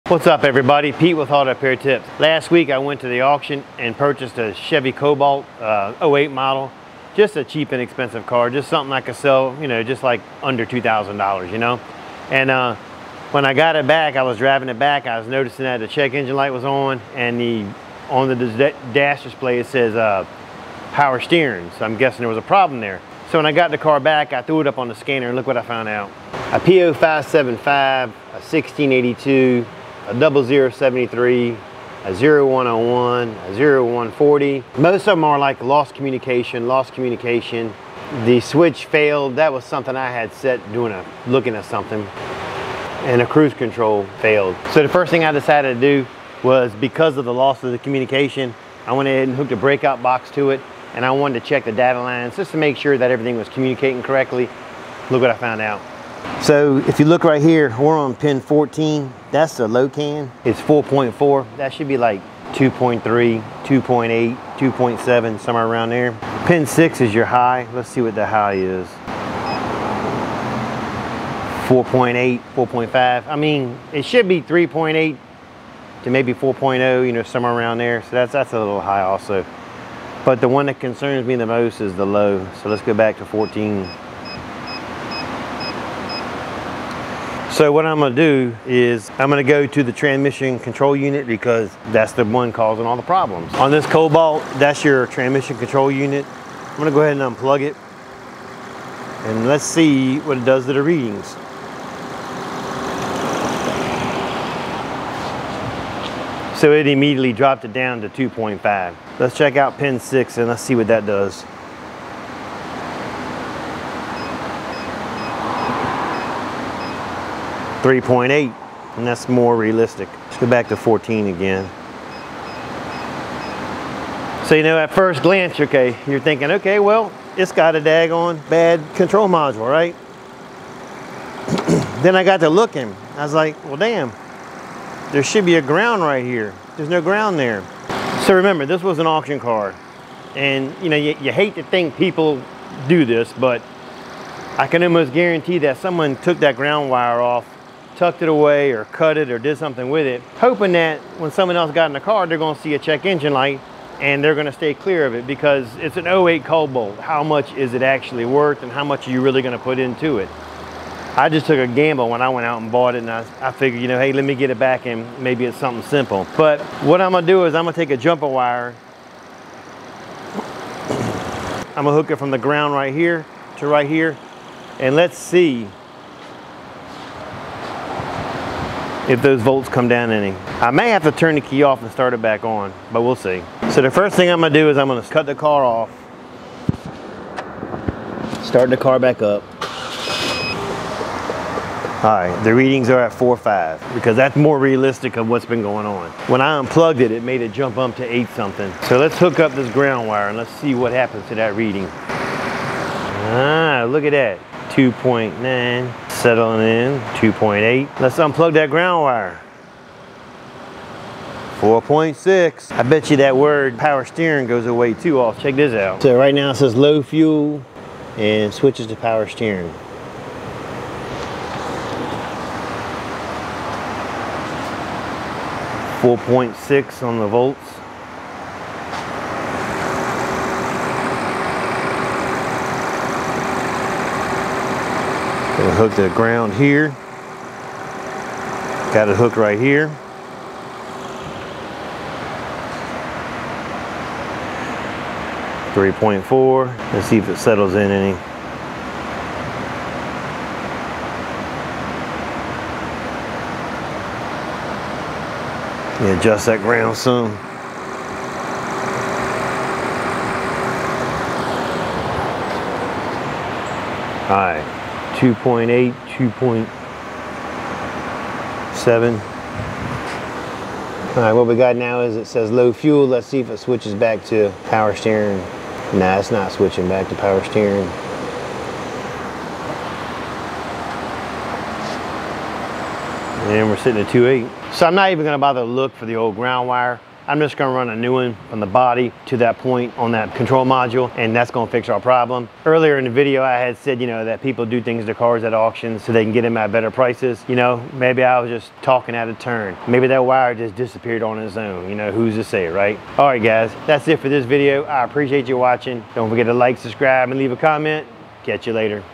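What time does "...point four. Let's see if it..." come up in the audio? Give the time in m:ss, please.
4:05.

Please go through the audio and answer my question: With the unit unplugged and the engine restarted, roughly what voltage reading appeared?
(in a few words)
8 something.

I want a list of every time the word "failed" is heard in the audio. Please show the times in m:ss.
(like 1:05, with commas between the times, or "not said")
0:38, 0:44.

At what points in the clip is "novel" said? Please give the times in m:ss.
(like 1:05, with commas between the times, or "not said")
not said.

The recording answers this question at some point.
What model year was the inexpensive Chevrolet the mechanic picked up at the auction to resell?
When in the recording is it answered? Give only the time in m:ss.
0:06.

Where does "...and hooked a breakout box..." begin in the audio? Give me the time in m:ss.
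0:49.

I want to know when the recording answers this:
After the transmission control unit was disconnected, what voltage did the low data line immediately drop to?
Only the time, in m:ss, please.
1:48.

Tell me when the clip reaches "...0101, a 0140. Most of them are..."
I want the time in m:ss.
0:32.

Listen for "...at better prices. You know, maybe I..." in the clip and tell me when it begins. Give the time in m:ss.
4:56.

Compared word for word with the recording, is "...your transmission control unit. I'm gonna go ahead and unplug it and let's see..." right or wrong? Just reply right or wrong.
right.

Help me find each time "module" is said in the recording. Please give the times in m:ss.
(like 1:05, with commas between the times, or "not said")
2:09, 4:50.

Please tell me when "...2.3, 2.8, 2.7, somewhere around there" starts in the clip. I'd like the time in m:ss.
1:02.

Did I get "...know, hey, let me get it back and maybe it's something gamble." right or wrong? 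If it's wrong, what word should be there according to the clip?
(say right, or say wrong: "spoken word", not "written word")
wrong: "simple", not "gamble".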